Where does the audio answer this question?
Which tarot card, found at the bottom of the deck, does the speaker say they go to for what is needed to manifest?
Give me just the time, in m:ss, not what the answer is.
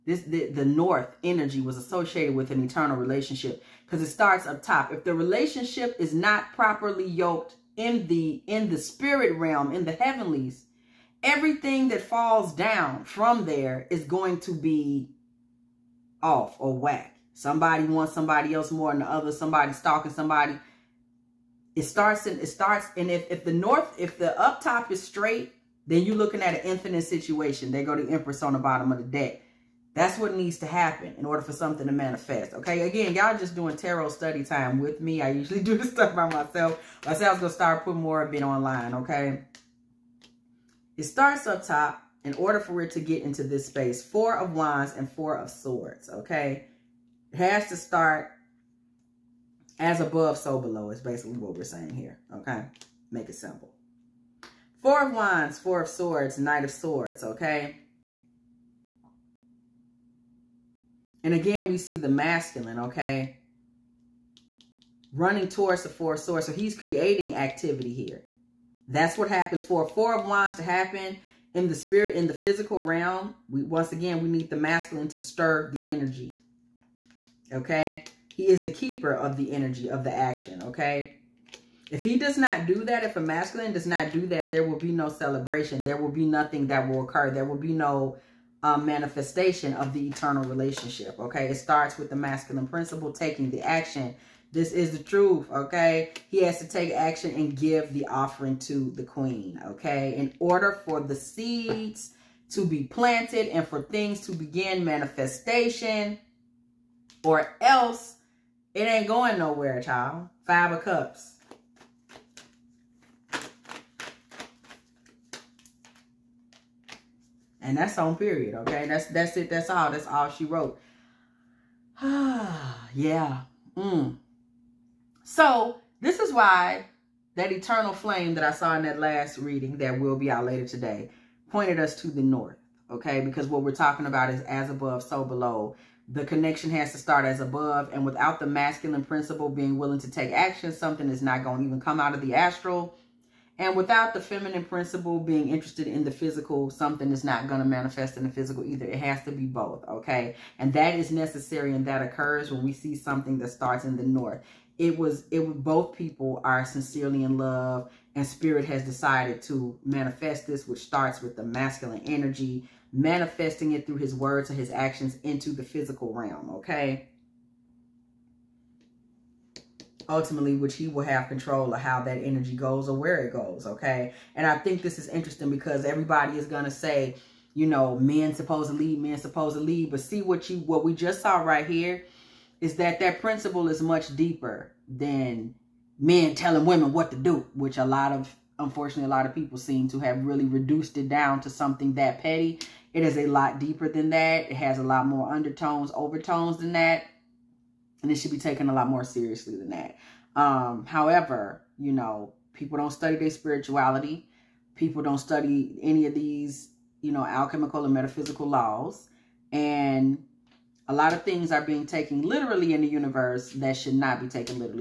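0:28.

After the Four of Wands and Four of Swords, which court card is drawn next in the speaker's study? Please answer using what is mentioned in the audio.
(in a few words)
Knight of Swords.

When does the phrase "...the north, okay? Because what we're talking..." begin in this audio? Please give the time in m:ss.
2:12.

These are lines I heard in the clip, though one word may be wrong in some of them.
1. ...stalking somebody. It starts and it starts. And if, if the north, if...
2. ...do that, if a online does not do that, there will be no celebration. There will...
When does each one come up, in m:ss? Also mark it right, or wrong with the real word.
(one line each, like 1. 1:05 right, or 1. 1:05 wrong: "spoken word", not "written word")
1. 0:19 right
2. 1:22 wrong: "masculine", not "online".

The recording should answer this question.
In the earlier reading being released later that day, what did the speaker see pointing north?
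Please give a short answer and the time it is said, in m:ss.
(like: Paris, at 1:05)
Eternal flame, at 2:07.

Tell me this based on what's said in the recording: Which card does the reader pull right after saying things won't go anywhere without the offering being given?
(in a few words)
Five of Cups.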